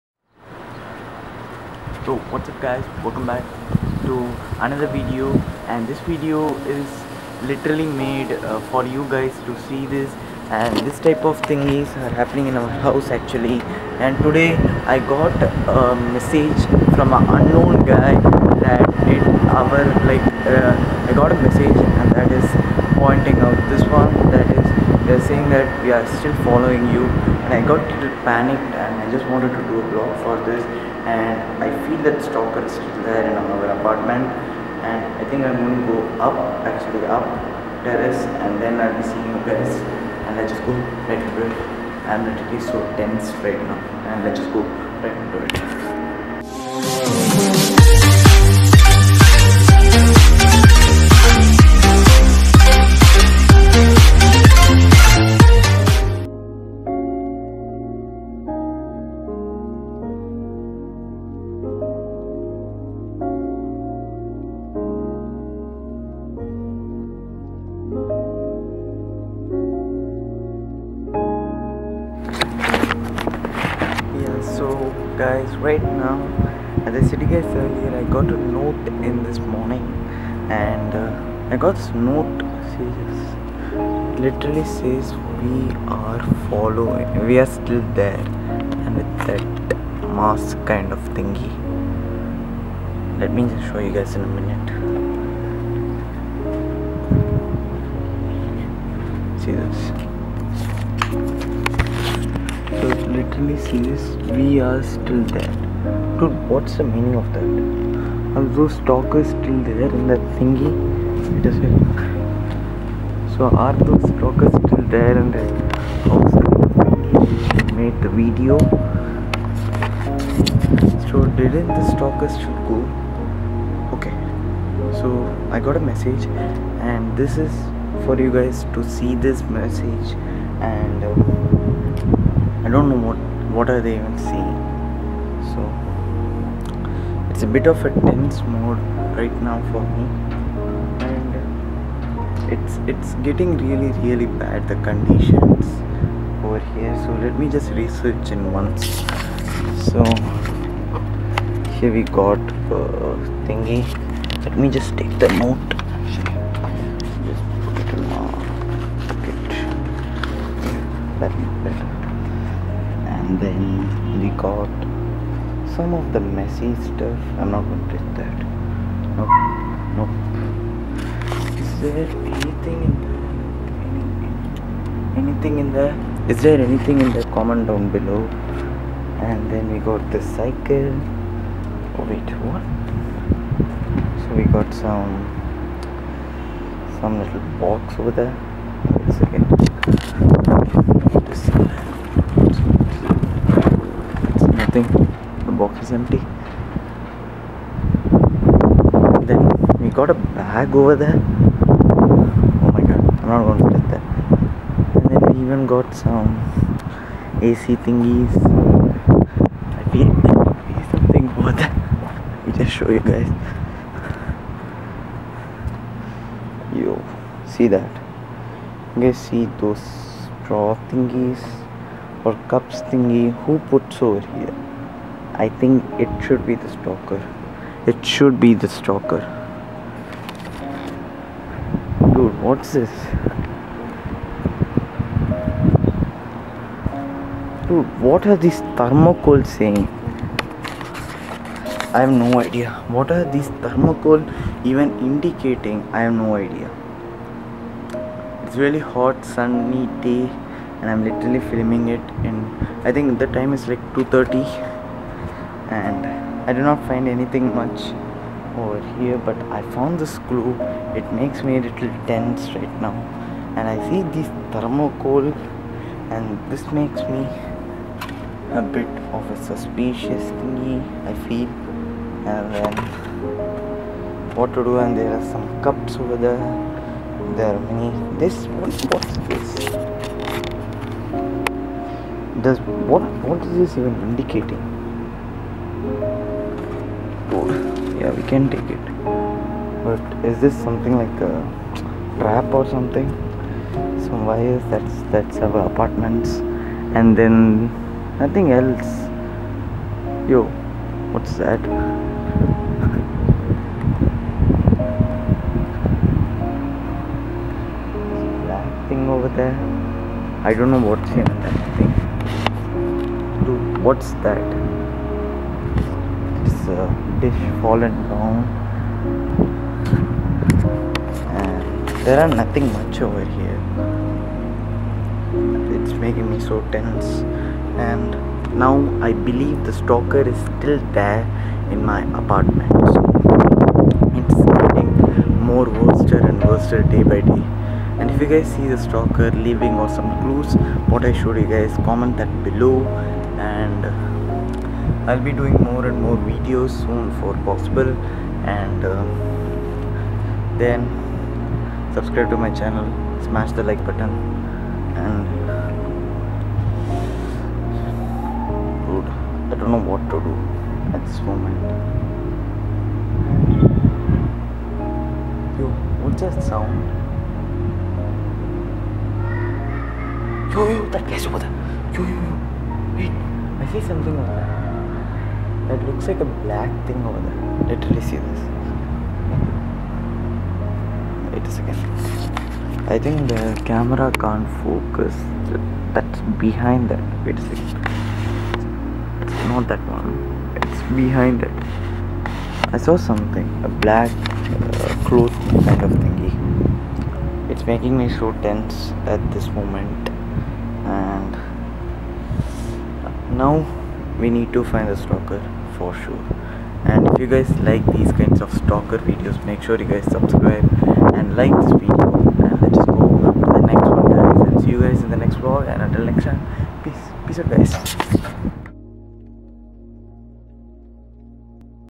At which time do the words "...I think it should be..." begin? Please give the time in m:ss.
3:45.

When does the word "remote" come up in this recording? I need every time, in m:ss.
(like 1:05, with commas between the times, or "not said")
not said.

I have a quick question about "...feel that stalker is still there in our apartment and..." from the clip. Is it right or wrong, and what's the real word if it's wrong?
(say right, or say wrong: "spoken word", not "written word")
right.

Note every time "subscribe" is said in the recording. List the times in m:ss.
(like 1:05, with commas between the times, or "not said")
5:51, 6:50.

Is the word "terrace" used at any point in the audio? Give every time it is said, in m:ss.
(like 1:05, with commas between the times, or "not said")
0:37.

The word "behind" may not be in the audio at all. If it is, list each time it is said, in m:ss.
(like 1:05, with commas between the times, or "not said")
6:26, 6:30.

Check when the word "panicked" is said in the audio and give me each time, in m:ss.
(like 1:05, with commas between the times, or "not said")
0:28.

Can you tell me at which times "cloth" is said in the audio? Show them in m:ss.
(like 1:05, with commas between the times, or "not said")
6:35.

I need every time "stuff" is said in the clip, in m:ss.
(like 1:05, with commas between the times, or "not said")
2:46.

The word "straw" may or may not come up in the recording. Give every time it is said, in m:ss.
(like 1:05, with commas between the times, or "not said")
3:39.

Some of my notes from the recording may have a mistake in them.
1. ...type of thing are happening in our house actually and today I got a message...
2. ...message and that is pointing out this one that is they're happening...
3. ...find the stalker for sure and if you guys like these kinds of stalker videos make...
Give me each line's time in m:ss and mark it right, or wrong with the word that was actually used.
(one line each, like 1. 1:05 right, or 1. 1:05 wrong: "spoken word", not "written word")
1. 0:10 right
2. 0:21 wrong: "saying", not "happening"
3. 6:44 right.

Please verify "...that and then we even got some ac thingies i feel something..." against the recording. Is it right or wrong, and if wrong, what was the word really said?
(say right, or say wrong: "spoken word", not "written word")
right.